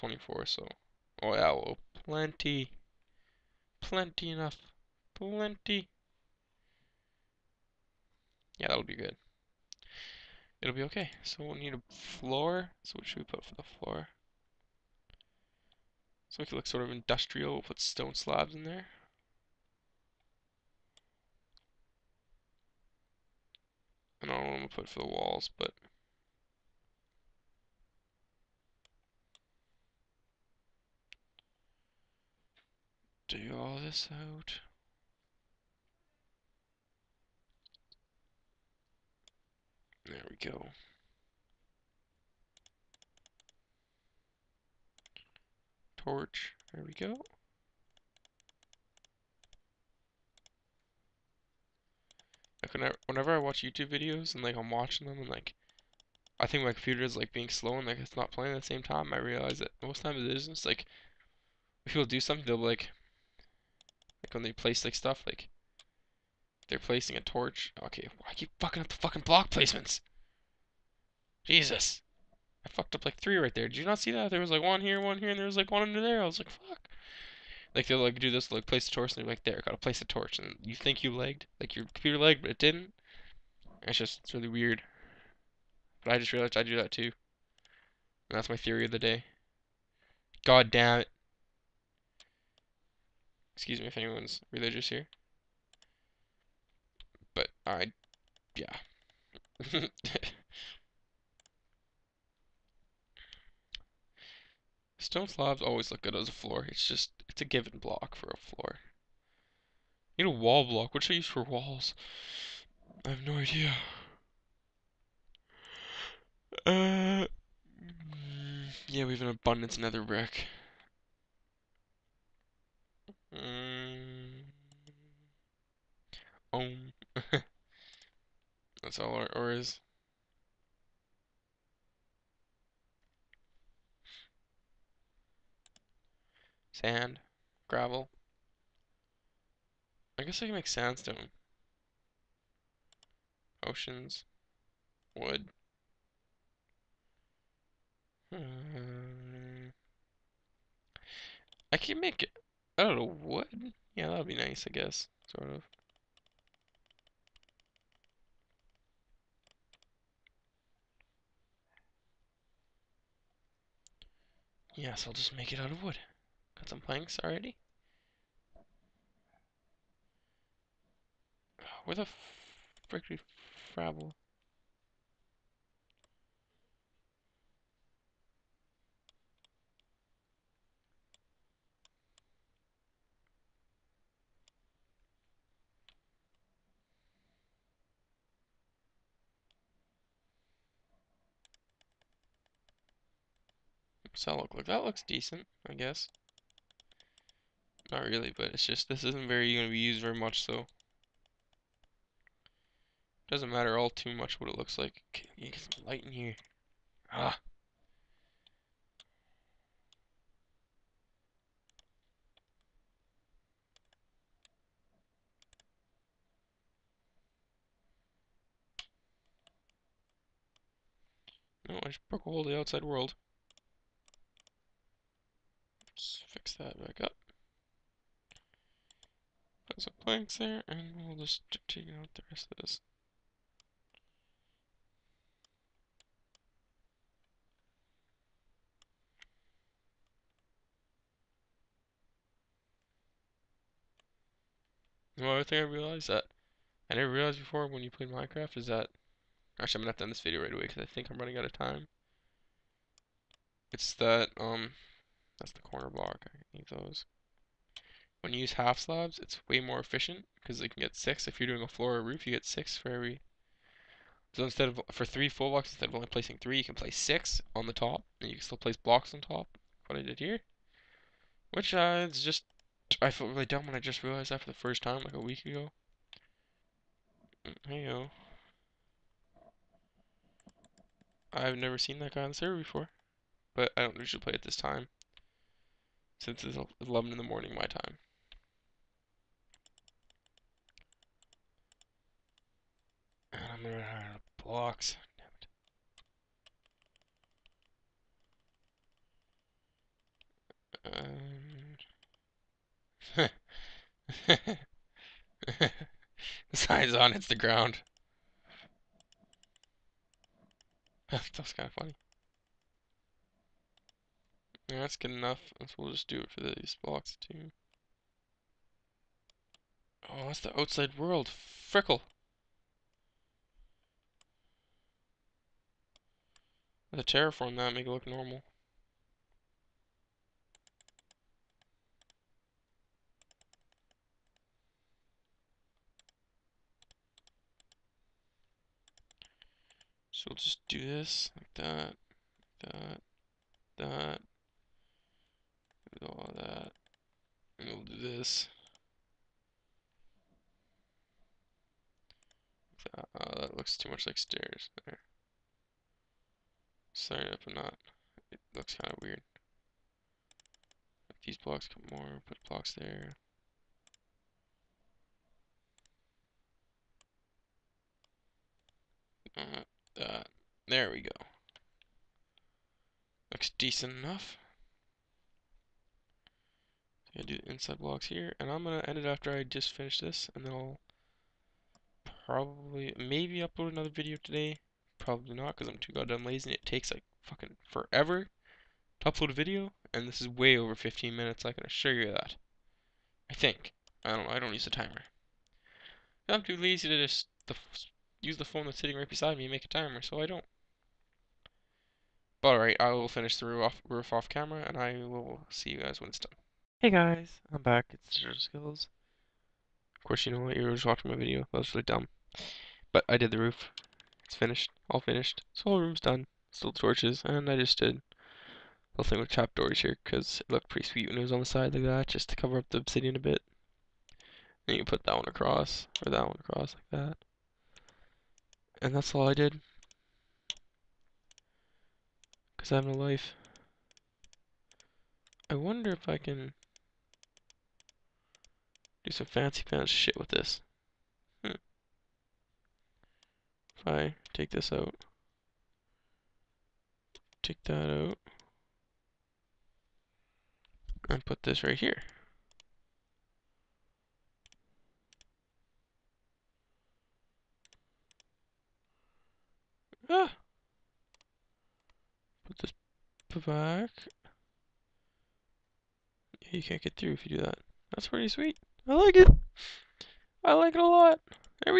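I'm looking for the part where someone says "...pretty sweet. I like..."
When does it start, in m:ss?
7:48.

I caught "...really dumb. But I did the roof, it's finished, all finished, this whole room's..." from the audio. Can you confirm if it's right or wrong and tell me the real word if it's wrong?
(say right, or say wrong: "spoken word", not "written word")
right.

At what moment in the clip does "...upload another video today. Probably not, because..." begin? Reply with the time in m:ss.
6:23.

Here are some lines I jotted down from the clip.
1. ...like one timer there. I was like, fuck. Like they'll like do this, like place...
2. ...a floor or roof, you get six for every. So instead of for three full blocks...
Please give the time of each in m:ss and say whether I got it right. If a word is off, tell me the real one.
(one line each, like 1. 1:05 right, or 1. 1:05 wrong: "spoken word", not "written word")
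1. 1:15 wrong: "under", not "timer"
2. 4:21 right.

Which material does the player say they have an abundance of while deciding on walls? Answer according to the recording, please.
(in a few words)
Nether brick.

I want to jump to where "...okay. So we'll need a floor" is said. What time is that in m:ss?
0:10.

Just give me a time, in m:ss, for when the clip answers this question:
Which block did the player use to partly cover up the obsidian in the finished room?
6:59.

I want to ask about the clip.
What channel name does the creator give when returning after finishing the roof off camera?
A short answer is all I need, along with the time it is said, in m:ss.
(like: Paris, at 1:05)
DigitalSkillz, at 6:48.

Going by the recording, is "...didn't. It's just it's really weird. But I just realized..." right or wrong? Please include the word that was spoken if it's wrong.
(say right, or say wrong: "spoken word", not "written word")
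right.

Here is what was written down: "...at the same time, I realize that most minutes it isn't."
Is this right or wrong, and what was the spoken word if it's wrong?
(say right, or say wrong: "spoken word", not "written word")
wrong: "times", not "minutes".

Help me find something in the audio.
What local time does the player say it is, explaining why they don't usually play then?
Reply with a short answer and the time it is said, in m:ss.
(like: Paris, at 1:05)
11 in the morning, at 4:46.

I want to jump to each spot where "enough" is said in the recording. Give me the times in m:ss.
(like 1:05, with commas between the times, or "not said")
0:04, 5:15, 6:13.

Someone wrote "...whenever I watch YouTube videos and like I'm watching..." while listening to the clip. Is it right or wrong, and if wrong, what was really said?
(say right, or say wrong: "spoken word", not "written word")
right.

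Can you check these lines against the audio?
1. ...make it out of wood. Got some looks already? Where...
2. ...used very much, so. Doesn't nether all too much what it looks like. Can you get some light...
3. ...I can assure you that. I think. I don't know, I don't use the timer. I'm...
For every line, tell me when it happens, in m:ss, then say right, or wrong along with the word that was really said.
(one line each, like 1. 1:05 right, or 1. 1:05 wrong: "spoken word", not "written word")
1. 2:45 wrong: "planks", not "looks"
2. 3:19 wrong: "matter", not "nether"
3. 6:31 right.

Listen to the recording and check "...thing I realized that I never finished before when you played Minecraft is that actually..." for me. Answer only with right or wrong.
wrong.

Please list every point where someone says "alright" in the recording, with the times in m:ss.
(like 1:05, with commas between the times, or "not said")
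6:42.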